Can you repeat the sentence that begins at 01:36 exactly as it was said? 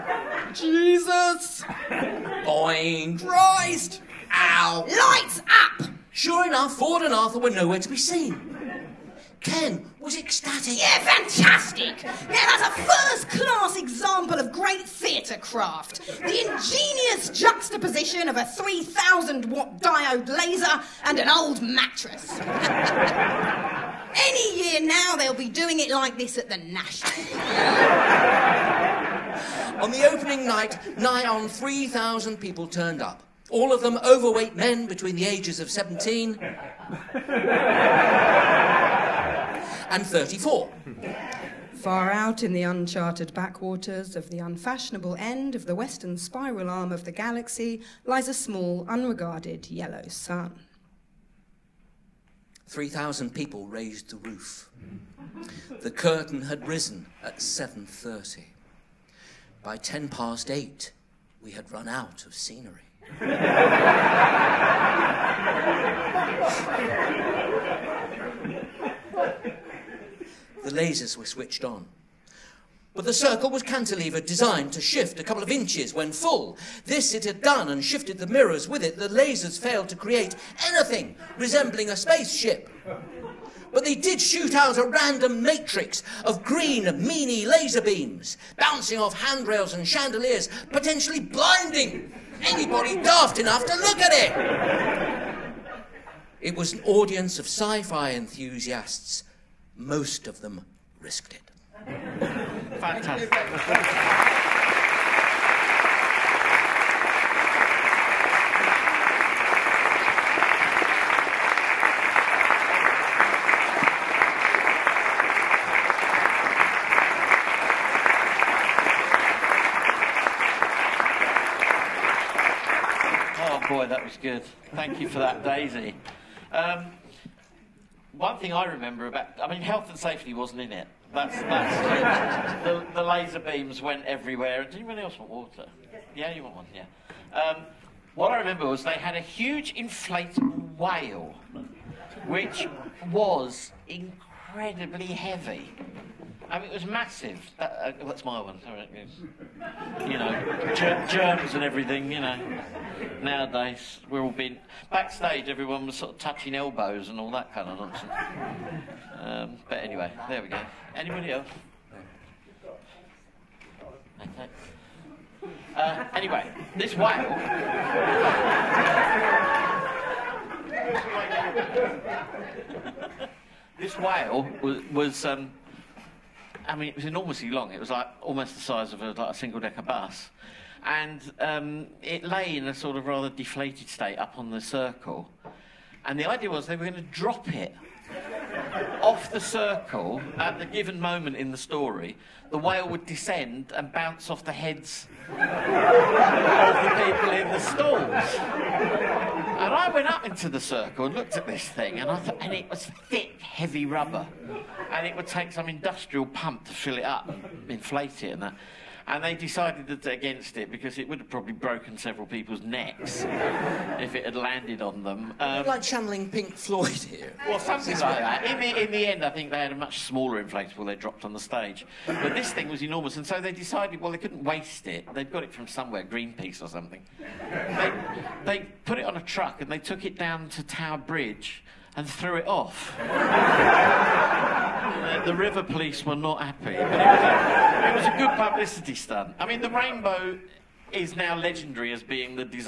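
It was an audience of sci fi enthusiasts.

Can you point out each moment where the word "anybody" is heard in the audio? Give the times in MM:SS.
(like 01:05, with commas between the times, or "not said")
01:32, 02:40.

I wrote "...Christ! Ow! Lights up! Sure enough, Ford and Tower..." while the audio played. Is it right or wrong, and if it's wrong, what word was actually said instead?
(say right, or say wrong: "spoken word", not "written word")
wrong: "Arthur", not "Tower".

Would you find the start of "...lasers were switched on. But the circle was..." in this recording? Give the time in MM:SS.
01:10.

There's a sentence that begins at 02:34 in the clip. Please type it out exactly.
Backstage, everyone was sort of touching elbows and all that kind of nonsense.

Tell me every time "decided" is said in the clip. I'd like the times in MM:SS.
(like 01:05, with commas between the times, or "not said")
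03:29, 03:43.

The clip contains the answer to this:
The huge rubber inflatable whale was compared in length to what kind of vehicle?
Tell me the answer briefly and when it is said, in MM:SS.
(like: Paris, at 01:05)
Single decker bus, at 02:59.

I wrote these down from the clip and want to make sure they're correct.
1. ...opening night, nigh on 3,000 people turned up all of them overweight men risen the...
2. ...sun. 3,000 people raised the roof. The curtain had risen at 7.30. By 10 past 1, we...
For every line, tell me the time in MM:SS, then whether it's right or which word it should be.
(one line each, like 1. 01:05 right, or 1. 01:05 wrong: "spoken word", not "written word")
1. 00:30 wrong: "between", not "risen"
2. 00:50 wrong: "8", not "1".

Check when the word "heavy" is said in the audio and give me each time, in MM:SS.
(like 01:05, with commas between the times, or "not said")
02:25, 03:23.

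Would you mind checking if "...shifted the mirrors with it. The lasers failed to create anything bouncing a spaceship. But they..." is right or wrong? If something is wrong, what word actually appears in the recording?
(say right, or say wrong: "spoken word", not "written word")
wrong: "resembling", not "bouncing".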